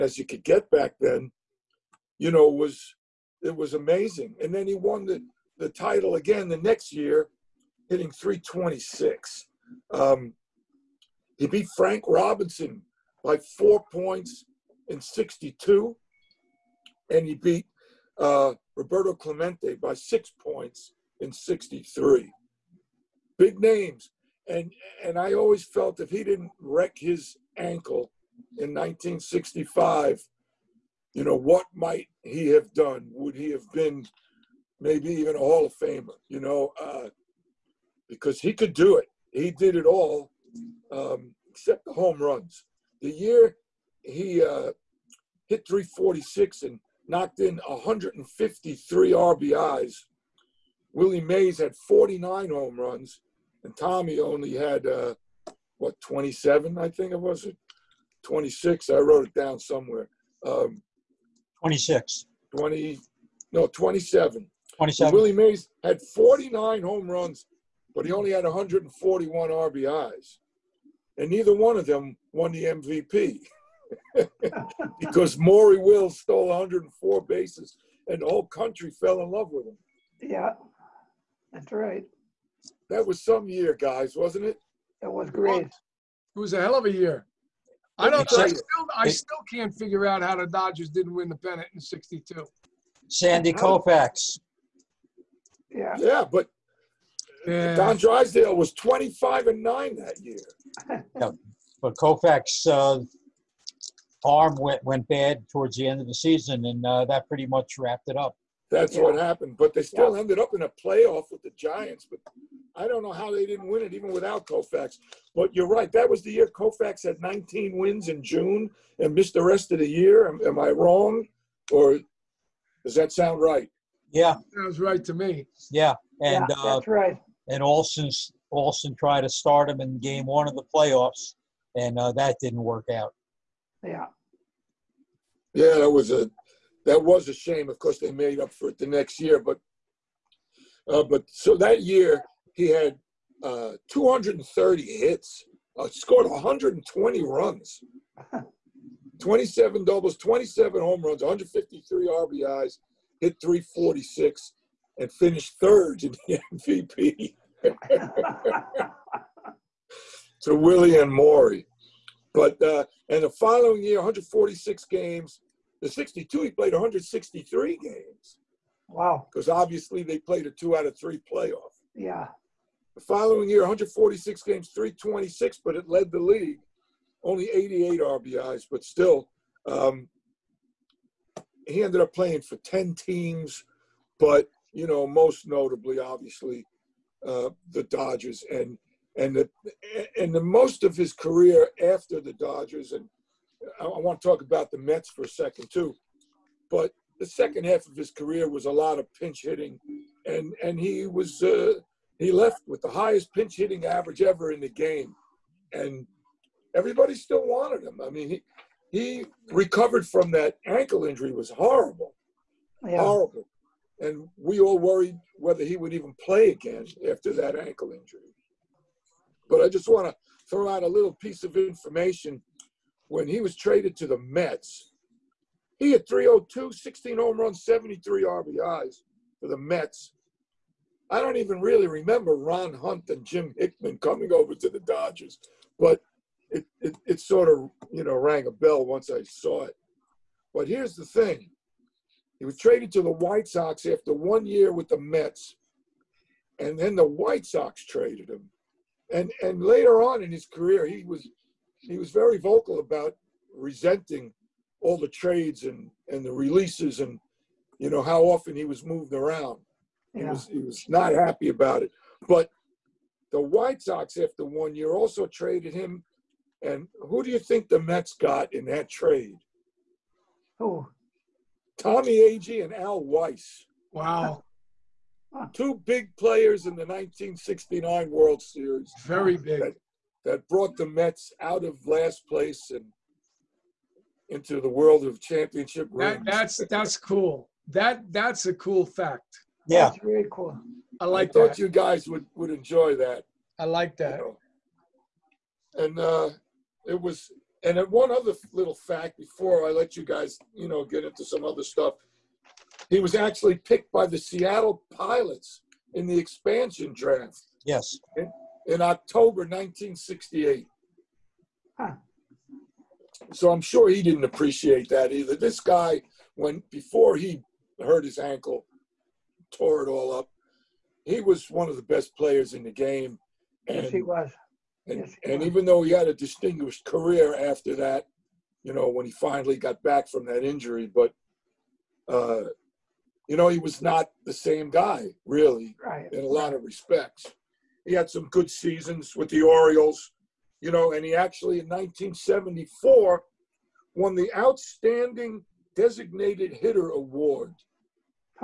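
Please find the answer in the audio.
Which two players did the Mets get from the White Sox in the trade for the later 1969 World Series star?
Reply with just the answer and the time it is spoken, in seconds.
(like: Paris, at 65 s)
Tommy Agee and Al Weis, at 271 s.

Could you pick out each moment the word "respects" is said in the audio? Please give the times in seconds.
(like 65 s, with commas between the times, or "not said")
336 s.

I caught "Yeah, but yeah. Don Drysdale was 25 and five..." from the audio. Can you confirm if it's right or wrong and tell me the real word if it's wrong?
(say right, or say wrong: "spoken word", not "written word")
wrong: "nine", not "five".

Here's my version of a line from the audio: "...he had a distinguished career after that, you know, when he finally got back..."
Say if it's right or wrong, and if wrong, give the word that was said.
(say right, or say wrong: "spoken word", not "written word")
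right.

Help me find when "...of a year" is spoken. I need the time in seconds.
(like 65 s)
86 s.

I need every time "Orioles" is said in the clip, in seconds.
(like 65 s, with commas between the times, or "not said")
339 s.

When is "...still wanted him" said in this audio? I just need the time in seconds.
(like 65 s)
207 s.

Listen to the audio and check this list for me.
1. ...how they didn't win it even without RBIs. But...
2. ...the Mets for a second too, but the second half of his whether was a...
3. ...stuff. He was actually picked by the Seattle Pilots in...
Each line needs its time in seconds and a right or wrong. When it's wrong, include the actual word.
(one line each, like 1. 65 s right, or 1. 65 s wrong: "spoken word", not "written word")
1. 113 s wrong: "Koufax", not "RBIs"
2. 194 s wrong: "career", not "whether"
3. 301 s right.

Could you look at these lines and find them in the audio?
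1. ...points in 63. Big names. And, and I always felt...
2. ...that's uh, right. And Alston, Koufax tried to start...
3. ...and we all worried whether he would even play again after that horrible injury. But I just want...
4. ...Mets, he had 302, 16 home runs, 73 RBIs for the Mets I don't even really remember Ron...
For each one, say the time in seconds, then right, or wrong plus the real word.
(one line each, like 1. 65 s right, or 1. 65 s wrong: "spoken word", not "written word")
1. 20 s right
2. 126 s wrong: "Alston", not "Koufax"
3. 213 s wrong: "ankle", not "horrible"
4. 224 s right.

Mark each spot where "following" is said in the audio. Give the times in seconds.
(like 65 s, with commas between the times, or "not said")
163 s, 173 s.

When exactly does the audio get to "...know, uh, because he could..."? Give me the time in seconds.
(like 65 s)
36 s.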